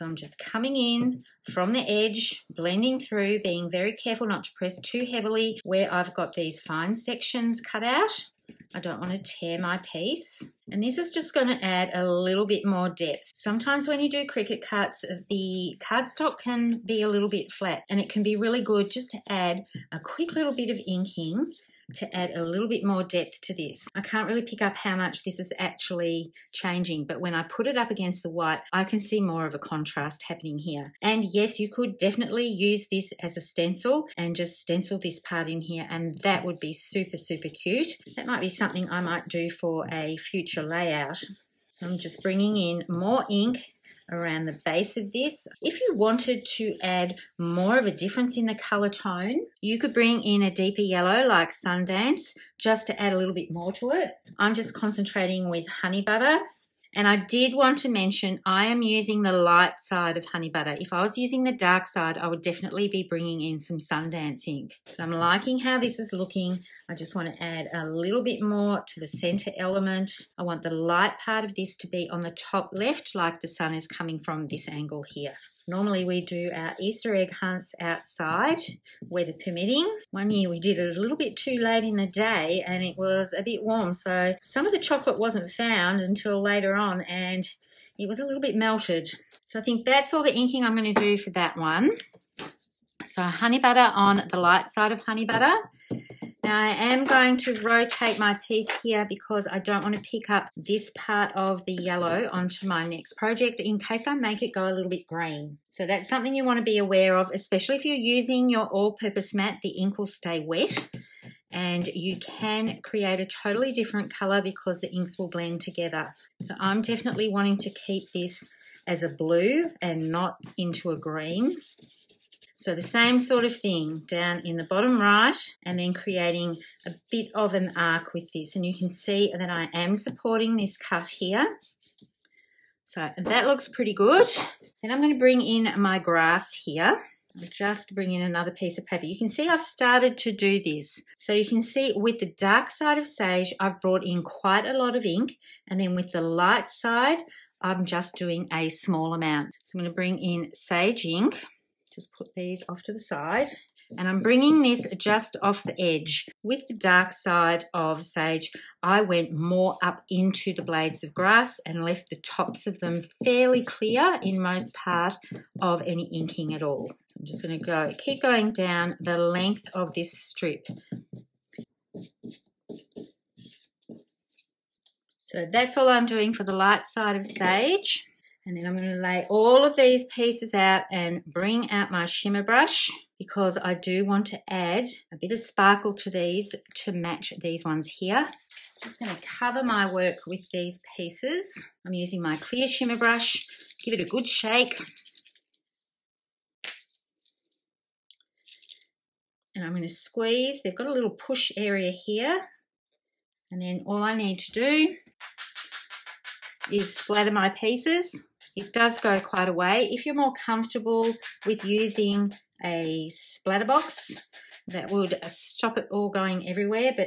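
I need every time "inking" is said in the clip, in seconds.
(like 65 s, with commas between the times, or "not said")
20 s, 90 s, 166 s.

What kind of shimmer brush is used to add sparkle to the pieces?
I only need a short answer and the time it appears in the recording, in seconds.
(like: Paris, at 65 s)
clear shimmer brush, at 192 s.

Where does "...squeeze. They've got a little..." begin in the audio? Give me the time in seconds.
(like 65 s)
199 s.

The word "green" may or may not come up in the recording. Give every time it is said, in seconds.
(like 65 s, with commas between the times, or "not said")
105 s, 120 s.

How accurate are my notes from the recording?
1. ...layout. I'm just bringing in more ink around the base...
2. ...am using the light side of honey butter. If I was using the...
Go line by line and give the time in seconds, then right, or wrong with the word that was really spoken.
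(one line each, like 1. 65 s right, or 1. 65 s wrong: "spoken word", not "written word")
1. 40 s right
2. 58 s right.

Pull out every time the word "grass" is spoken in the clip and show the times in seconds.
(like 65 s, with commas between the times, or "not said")
135 s, 161 s.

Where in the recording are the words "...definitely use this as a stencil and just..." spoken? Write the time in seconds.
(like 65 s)
31 s.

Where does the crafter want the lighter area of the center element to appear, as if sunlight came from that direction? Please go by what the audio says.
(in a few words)
top left.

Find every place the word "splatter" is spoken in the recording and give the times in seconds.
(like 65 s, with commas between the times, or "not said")
206 s, 213 s.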